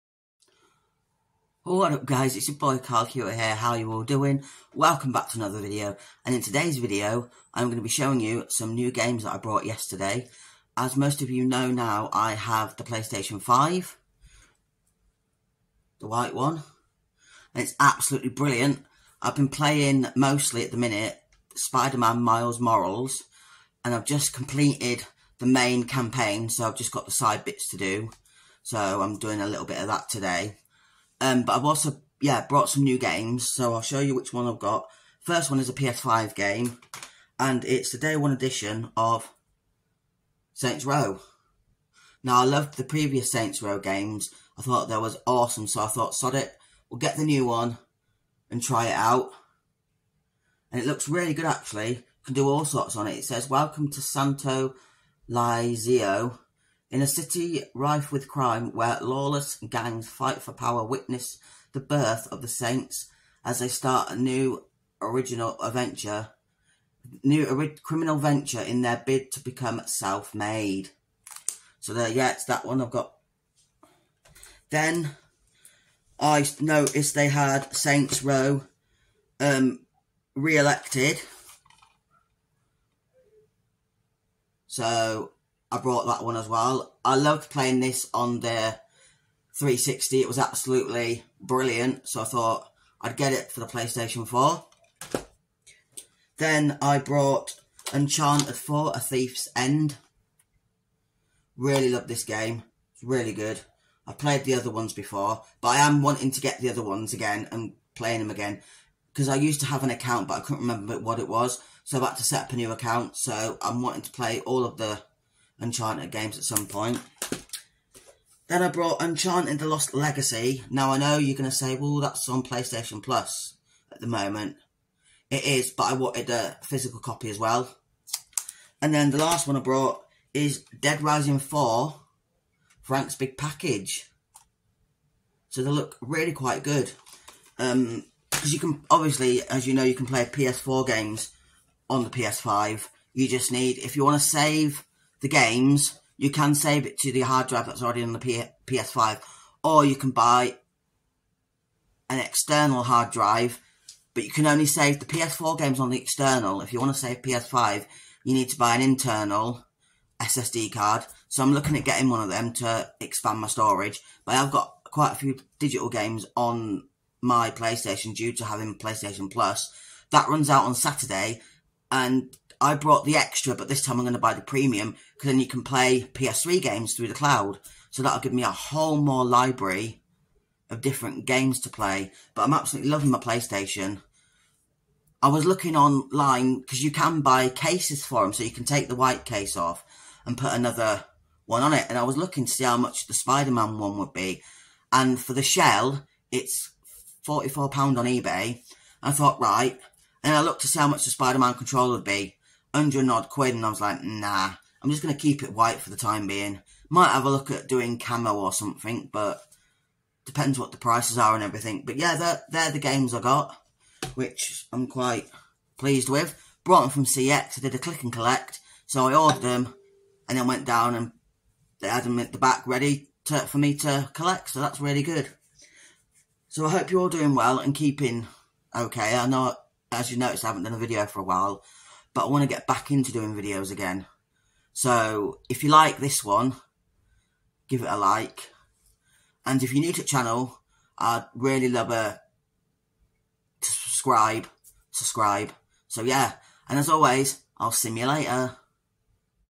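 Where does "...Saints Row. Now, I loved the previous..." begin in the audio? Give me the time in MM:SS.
00:40.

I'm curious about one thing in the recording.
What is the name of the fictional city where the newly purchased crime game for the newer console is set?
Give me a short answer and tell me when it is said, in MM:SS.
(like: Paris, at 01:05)
Santo Ileso, at 00:54.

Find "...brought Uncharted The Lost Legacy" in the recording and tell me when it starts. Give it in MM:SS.
01:58.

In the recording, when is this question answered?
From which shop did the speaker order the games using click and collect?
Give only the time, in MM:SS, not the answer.
03:37.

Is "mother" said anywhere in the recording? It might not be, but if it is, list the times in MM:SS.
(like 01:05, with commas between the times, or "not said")
not said.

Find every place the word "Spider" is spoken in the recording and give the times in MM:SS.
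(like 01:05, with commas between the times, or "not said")
00:21, 03:13, 03:21.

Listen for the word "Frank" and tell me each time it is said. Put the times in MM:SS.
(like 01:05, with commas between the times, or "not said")
02:12.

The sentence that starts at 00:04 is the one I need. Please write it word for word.
Welcome back to another video, and in today's video, I'm going to be showing you some new games that I brought yesterday.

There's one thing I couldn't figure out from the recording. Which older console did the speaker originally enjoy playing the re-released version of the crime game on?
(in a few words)
360.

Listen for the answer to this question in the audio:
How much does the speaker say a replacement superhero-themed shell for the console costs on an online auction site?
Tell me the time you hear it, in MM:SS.
03:17.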